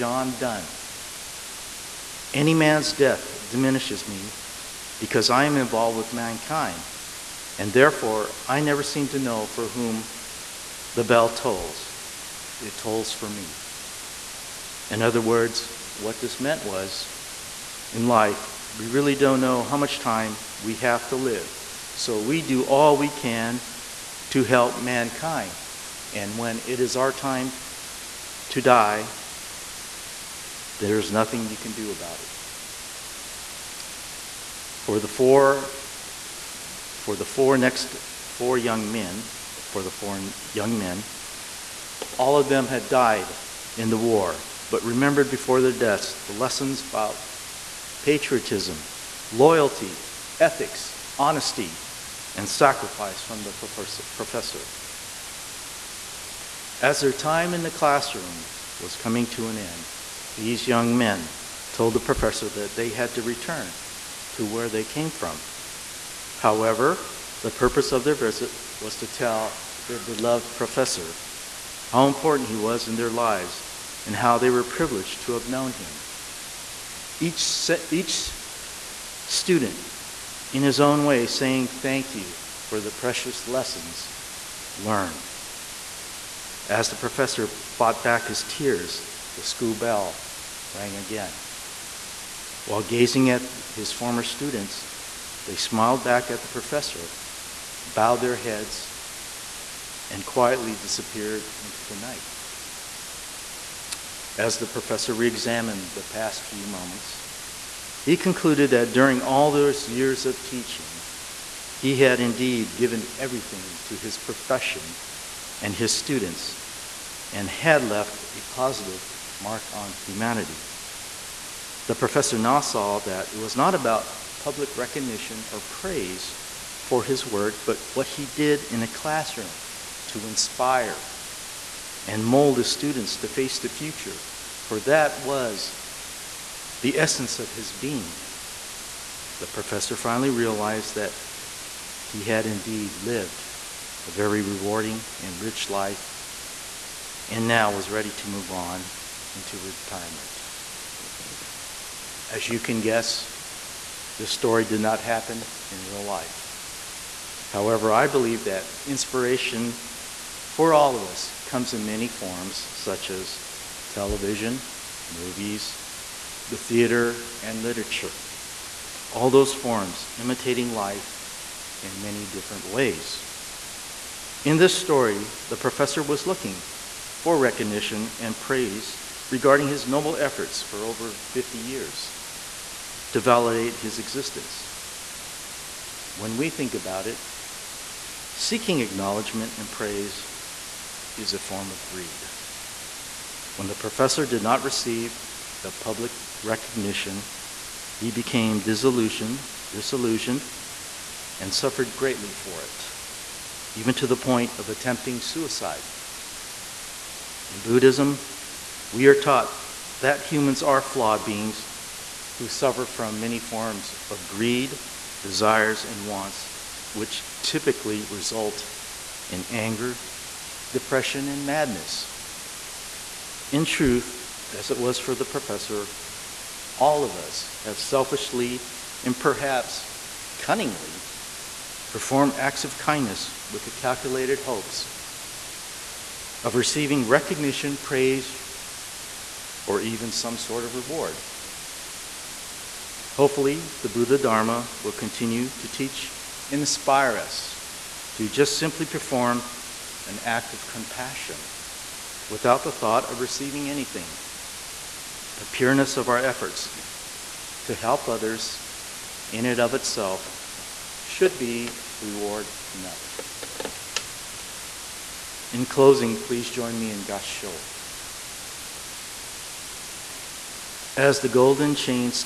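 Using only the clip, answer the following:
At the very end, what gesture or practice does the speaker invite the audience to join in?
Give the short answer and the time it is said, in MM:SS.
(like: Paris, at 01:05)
Gasho, at 04:27.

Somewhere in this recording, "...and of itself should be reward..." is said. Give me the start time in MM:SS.
04:19.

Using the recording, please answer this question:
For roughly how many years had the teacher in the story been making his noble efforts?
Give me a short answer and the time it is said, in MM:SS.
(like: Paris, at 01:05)
50, at 03:01.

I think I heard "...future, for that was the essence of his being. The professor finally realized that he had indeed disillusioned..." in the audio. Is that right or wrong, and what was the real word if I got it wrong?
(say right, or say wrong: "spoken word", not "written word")
wrong: "lived", not "disillusioned".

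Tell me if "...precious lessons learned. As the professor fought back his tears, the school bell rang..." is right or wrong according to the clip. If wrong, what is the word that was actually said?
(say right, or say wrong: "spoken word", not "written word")
right.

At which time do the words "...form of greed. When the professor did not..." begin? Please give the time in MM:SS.
03:11.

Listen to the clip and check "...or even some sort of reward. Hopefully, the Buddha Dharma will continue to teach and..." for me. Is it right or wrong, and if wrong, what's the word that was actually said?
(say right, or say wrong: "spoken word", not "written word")
right.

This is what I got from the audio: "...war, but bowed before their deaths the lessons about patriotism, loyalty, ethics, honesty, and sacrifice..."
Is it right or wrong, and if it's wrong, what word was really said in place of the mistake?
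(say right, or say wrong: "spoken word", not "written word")
wrong: "remembered", not "bowed".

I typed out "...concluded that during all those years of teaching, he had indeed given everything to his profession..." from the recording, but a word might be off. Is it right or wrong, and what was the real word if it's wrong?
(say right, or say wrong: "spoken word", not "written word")
right.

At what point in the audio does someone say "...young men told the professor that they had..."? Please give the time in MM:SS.
01:00.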